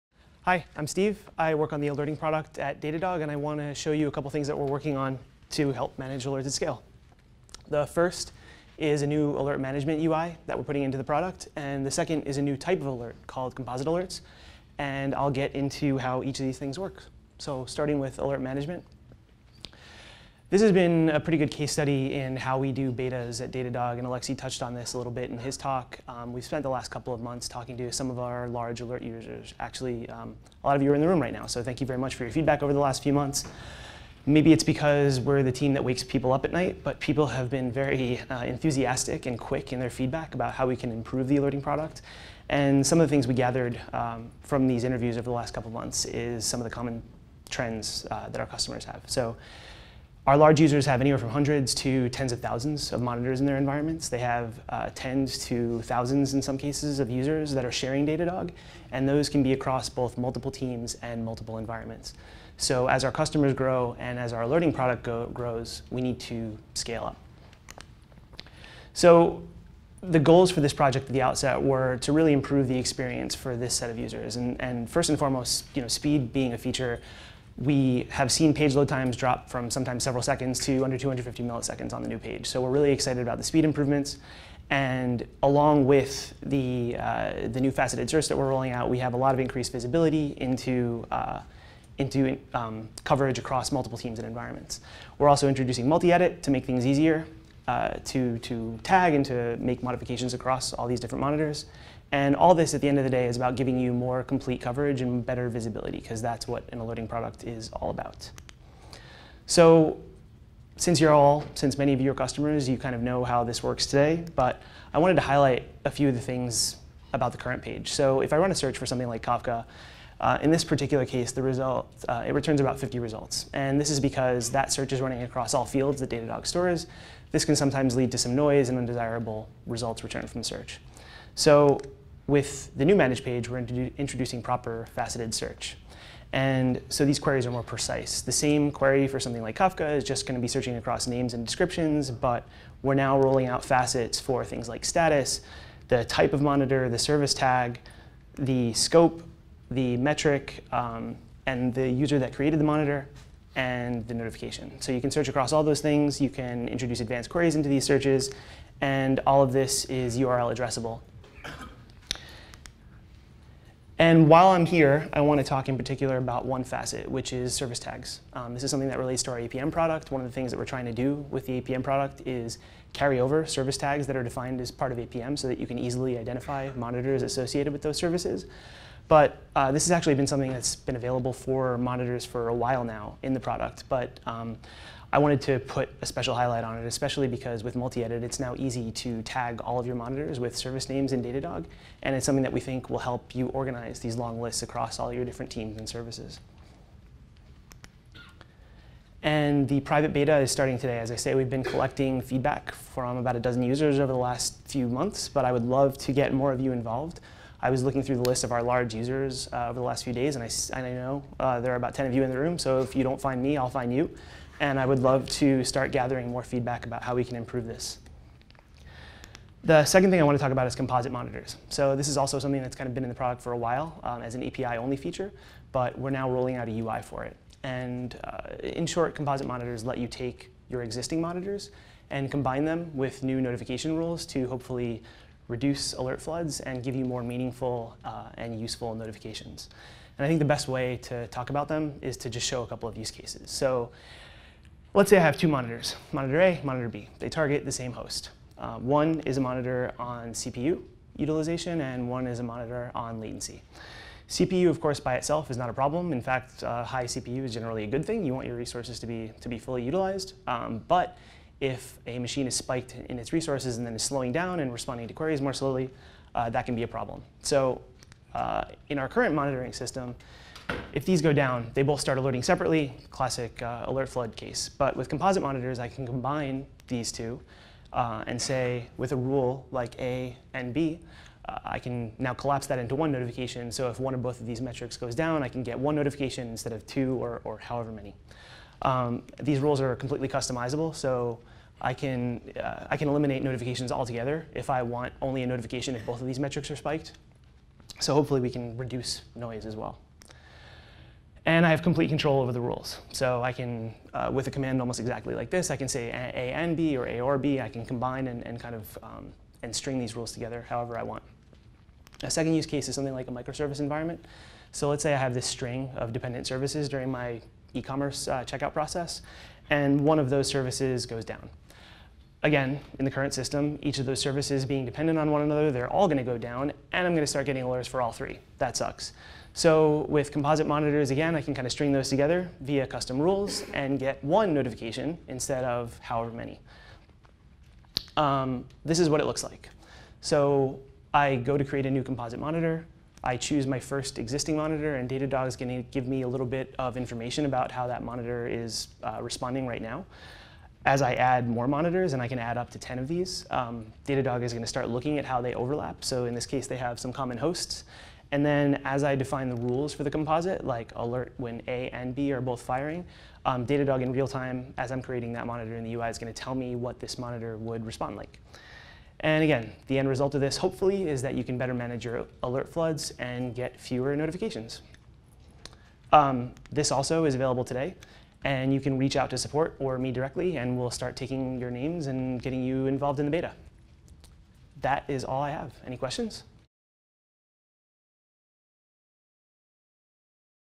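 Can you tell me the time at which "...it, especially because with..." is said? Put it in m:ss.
3:06.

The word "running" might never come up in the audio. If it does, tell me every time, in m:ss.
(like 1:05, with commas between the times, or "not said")
2:05.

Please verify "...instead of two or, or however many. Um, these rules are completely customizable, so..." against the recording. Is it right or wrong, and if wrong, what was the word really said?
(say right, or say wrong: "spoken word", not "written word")
right.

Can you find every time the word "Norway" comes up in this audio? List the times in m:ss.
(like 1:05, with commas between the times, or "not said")
not said.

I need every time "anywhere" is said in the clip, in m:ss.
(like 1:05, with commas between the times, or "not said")
0:51.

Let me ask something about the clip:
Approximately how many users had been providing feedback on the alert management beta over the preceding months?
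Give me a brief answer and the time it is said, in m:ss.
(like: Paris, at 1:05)
about a dozen, at 3:23.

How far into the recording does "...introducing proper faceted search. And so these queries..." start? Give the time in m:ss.
2:13.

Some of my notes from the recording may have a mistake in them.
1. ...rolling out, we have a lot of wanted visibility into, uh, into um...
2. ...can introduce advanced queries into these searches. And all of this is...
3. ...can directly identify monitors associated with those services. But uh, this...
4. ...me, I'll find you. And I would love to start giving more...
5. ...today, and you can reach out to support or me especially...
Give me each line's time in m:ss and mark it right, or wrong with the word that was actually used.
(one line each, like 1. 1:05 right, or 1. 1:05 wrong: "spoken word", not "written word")
1. 1:28 wrong: "increased", not "wanted"
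2. 2:36 right
3. 2:55 wrong: "easily", not "directly"
4. 3:33 wrong: "gathering", not "giving"
5. 6:17 wrong: "directly", not "especially".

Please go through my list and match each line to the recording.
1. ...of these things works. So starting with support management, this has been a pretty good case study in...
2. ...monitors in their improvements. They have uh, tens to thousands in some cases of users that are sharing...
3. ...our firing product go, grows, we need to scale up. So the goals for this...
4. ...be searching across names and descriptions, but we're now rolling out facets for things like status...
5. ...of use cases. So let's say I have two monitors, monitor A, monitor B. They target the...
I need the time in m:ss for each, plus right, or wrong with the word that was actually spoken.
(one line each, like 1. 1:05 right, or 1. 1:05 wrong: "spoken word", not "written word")
1. 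0:16 wrong: "alert", not "support"
2. 0:53 wrong: "environments", not "improvements"
3. 1:04 wrong: "alerting", not "firing"
4. 2:20 right
5. 4:02 right.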